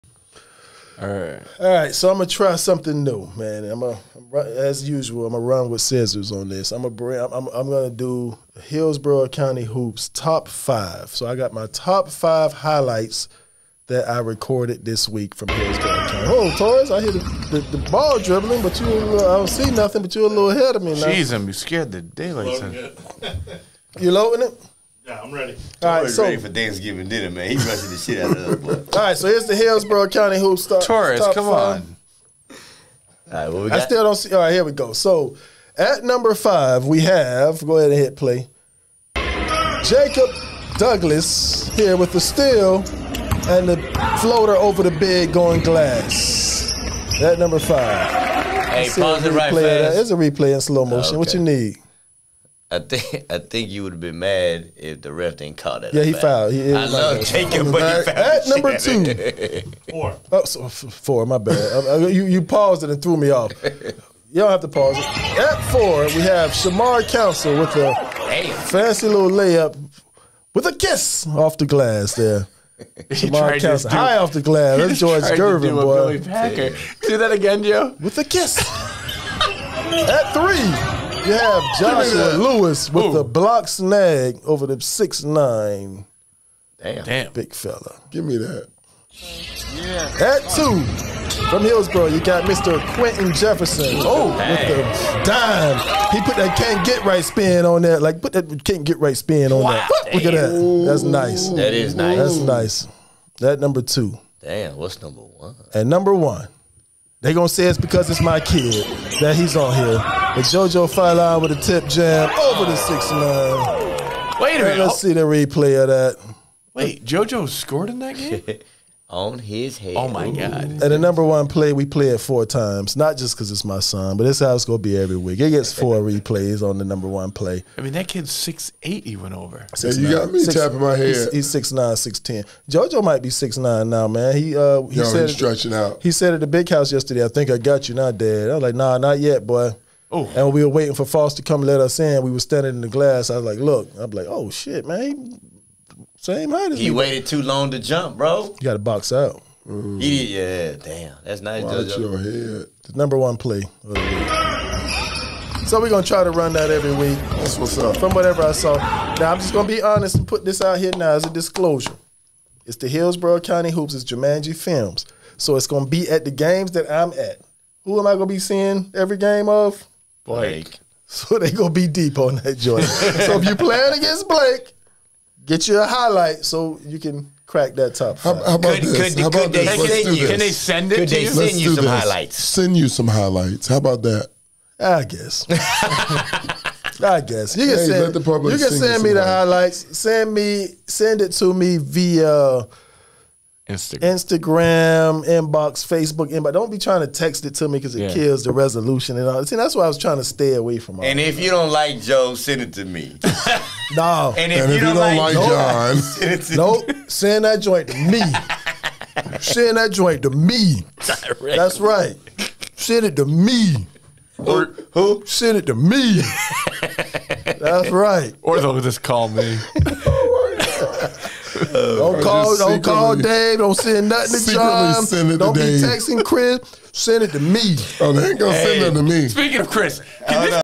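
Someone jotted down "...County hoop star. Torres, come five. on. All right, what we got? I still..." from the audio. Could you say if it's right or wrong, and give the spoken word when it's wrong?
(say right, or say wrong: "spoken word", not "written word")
right.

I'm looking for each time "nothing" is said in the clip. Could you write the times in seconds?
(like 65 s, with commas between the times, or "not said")
19 s, 224 s, 228 s.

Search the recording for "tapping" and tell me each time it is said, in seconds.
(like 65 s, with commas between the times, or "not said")
130 s.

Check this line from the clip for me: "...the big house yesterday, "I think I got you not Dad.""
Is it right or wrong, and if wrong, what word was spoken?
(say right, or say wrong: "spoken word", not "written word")
right.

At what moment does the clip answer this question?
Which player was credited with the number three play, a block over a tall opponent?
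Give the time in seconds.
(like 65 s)
81 s.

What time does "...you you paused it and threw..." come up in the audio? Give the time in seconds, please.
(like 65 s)
62 s.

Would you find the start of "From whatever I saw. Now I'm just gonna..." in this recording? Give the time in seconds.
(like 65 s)
157 s.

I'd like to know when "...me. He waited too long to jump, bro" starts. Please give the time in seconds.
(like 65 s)
146 s.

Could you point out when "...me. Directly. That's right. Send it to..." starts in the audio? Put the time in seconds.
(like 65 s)
210 s.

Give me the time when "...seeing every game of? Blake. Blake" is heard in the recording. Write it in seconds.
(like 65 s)
168 s.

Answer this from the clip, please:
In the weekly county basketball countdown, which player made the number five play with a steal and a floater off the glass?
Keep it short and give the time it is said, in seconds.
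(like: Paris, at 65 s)
Jacob Douglas, at 39 s.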